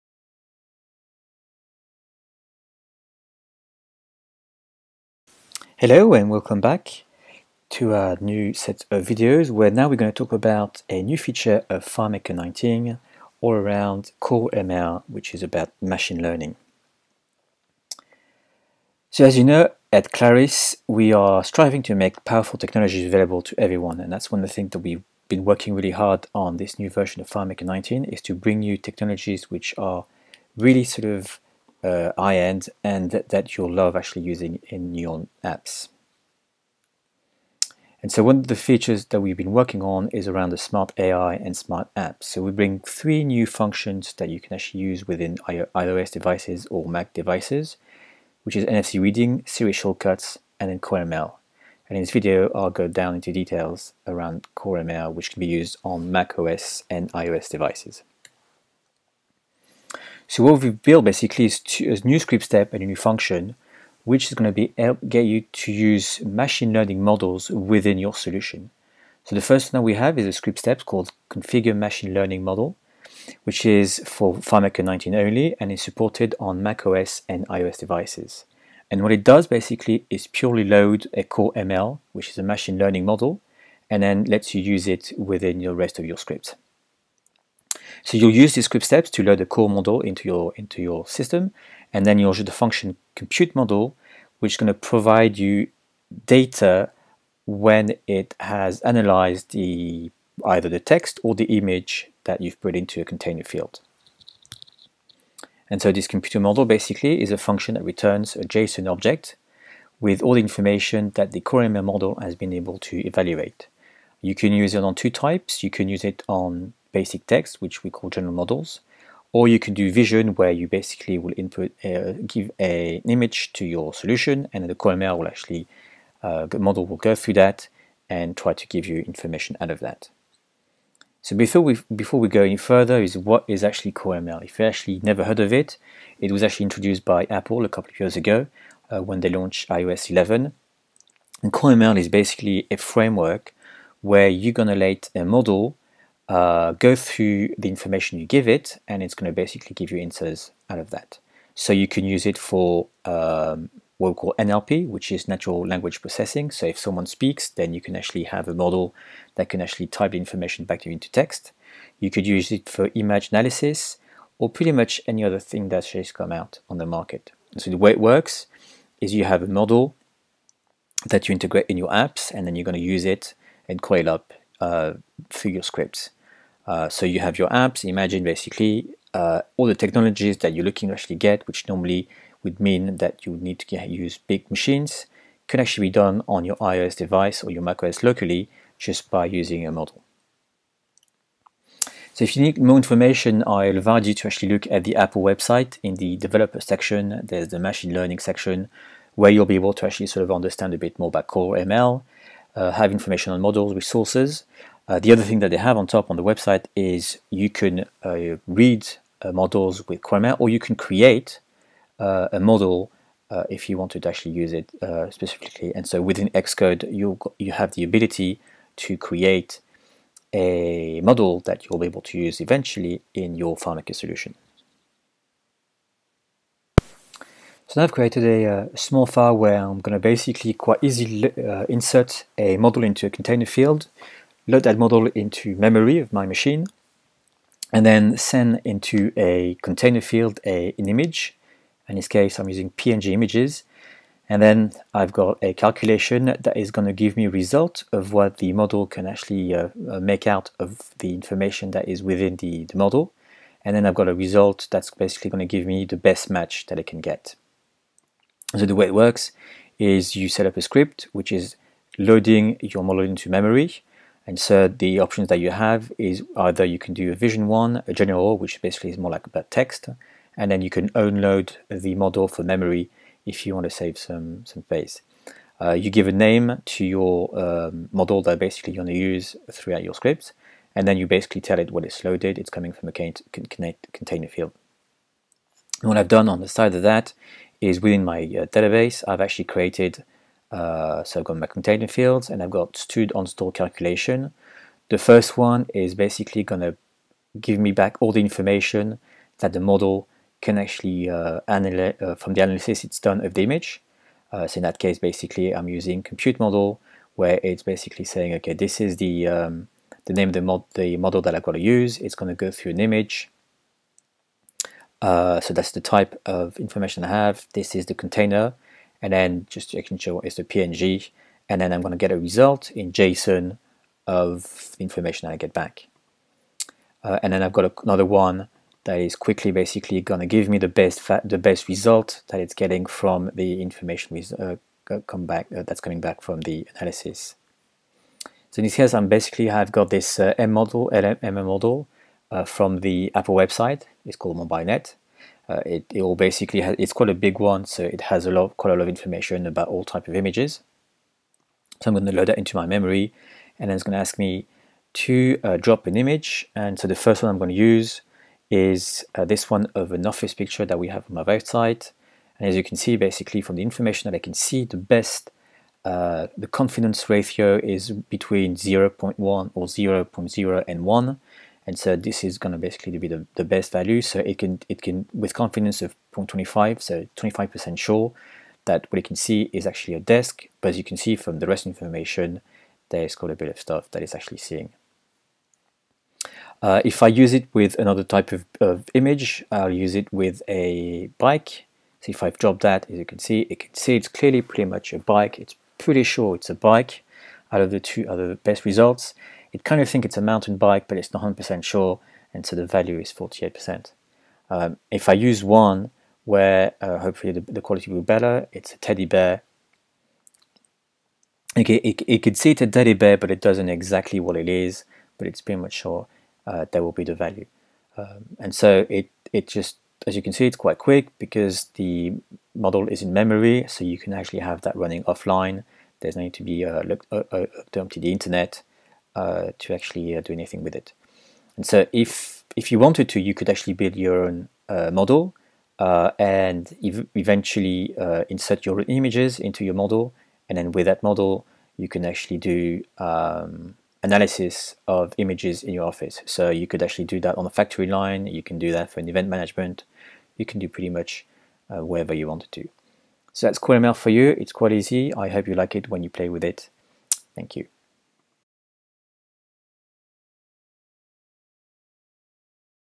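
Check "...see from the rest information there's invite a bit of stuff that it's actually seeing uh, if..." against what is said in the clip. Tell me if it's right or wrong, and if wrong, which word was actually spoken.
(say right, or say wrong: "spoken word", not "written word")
wrong: "quite", not "invite".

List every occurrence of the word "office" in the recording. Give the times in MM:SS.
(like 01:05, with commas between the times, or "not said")
06:00, 07:25.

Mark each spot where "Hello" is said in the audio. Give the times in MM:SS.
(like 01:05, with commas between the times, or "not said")
00:05.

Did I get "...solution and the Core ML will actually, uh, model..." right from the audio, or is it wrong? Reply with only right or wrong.
right.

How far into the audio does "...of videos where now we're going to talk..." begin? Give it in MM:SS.
00:08.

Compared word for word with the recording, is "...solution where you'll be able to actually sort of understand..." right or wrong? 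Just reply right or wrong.
wrong.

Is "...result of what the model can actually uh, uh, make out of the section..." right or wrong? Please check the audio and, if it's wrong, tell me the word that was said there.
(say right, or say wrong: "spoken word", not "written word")
wrong: "information", not "section".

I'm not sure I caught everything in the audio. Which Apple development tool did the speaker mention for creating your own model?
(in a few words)
Xcode.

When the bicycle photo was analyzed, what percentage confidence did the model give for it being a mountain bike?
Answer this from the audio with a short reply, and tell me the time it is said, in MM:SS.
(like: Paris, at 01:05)
48%, at 06:43.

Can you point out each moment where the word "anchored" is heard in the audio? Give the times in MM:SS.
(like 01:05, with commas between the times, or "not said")
not said.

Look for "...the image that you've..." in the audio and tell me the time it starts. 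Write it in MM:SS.
01:41.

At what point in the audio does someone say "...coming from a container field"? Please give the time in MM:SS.
04:42.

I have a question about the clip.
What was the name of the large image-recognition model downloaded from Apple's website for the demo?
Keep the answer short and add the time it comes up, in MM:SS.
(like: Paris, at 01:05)
MobileNet, at 05:44.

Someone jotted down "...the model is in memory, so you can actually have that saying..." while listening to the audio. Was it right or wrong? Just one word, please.
wrong.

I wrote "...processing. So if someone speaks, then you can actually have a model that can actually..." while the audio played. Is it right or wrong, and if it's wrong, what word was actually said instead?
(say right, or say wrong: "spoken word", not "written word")
right.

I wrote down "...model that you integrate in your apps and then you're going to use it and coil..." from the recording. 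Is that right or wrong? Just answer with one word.
right.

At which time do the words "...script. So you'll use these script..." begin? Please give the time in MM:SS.
01:26.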